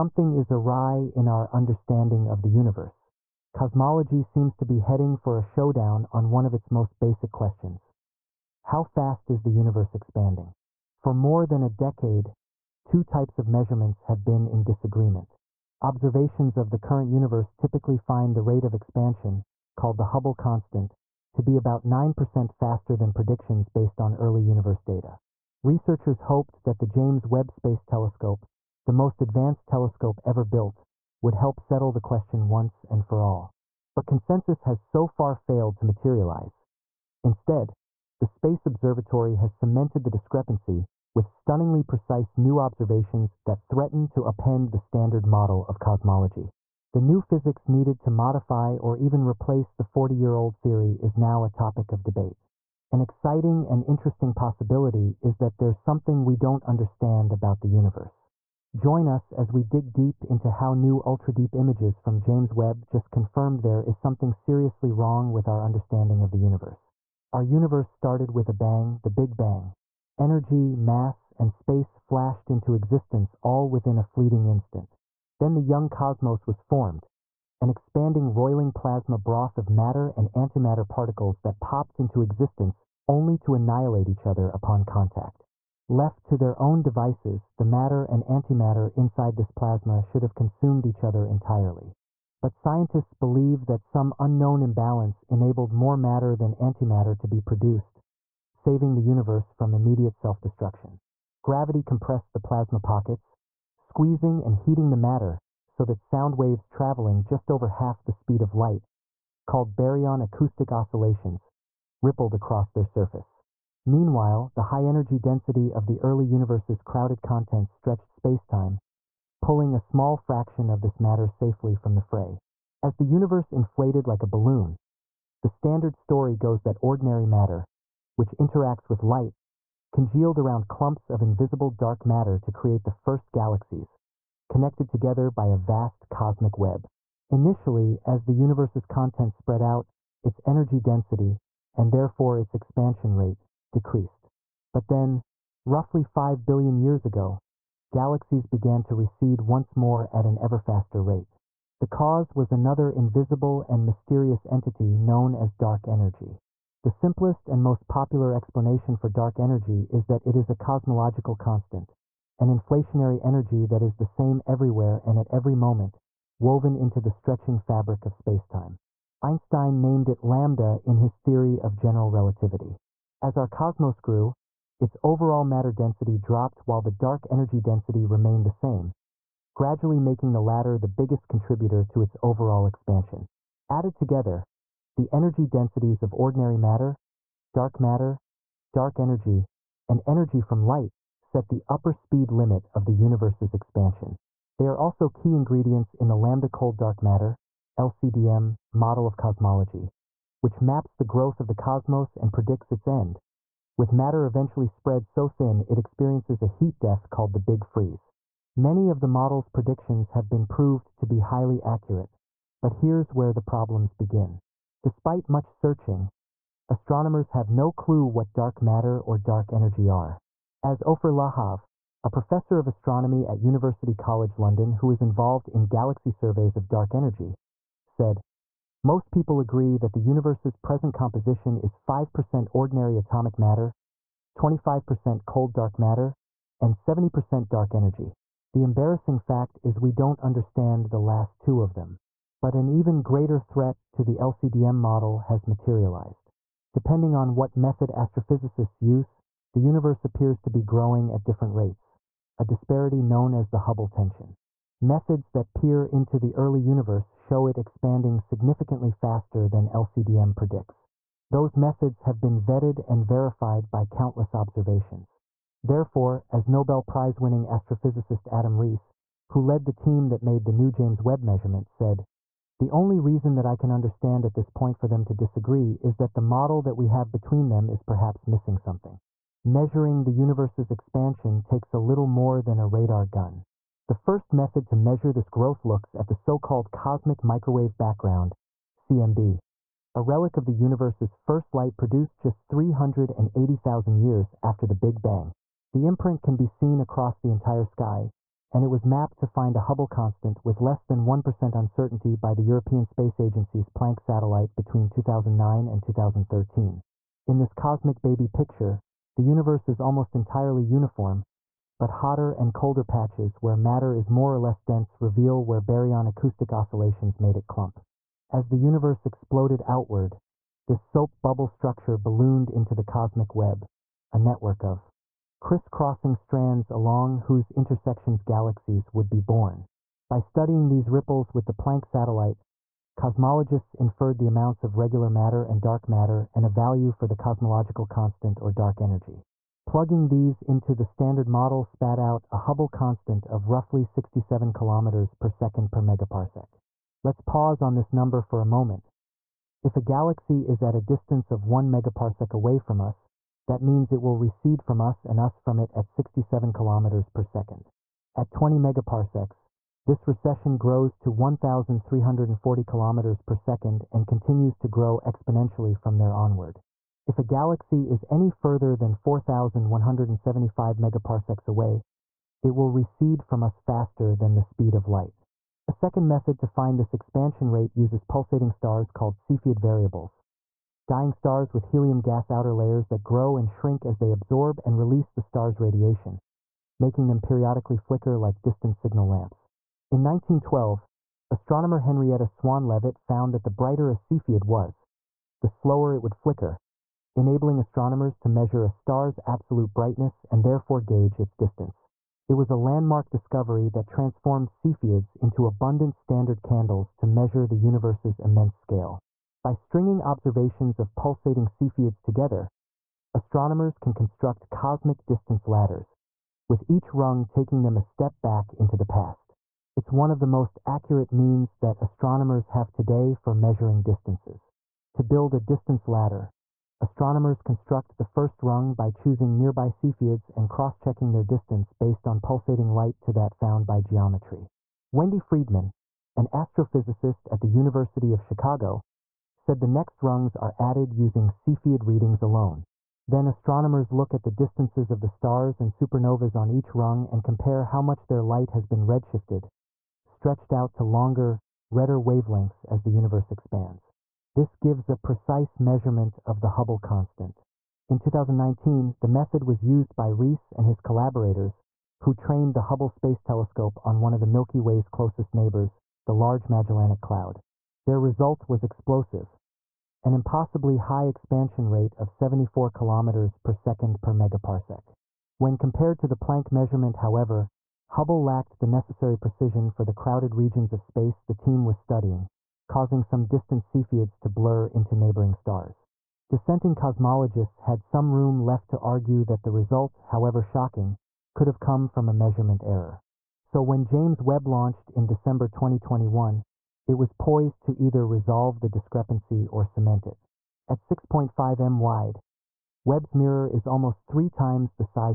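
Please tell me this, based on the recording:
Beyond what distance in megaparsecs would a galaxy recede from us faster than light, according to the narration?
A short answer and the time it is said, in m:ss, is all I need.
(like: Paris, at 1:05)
4,175 megaparsecs, at 6:08.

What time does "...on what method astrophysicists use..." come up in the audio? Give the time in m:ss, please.
4:07.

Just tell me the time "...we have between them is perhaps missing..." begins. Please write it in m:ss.
4:36.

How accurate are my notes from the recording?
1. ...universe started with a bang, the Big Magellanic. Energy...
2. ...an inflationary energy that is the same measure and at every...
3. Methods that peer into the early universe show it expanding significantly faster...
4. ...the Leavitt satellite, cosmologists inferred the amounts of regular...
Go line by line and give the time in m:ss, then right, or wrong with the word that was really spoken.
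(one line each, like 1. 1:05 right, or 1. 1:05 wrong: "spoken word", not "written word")
1. 1:07 wrong: "Bang", not "Magellanic"
2. 2:42 wrong: "everywhere", not "measure"
3. 4:14 right
4. 5:31 wrong: "Planck", not "Leavitt".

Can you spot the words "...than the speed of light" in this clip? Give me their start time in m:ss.
6:14.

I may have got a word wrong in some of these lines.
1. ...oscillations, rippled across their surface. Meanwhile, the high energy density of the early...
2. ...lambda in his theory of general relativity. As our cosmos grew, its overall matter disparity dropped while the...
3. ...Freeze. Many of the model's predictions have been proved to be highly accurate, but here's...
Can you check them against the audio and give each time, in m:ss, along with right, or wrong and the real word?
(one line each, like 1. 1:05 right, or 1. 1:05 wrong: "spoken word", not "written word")
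1. 1:50 right
2. 2:50 wrong: "density", not "disparity"
3. 3:27 right.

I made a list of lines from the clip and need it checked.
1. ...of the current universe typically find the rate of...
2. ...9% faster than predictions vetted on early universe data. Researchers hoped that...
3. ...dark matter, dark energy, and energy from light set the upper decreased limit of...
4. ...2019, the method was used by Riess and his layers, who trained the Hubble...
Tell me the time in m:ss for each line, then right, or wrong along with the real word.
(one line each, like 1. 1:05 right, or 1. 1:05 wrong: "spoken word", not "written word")
1. 0:16 right
2. 0:21 wrong: "based", not "vetted"
3. 3:07 wrong: "speed", not "decreased"
4. 7:37 wrong: "collaborators", not "layers".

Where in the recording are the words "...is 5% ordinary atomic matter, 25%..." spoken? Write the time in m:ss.
3:51.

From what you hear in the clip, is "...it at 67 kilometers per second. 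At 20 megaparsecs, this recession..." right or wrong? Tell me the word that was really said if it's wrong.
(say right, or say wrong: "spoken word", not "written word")
right.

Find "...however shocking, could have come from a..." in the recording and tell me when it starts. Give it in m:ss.
8:10.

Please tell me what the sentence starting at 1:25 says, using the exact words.
Left to their own devices, the matter and antimatter inside this plasma should have consumed each other entirely.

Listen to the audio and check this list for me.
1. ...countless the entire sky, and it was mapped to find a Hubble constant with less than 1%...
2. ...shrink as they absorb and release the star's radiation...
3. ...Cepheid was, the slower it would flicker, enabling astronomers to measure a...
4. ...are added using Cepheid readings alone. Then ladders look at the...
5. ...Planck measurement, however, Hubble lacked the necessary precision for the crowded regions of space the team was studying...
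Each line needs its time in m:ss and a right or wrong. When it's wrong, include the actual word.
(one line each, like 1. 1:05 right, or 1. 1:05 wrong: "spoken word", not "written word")
1. 4:56 wrong: "across", not "countless"
2. 6:23 right
3. 6:33 right
4. 7:20 wrong: "astronomers", not "ladders"
5. 7:56 right.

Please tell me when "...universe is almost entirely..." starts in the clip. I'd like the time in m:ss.
5:09.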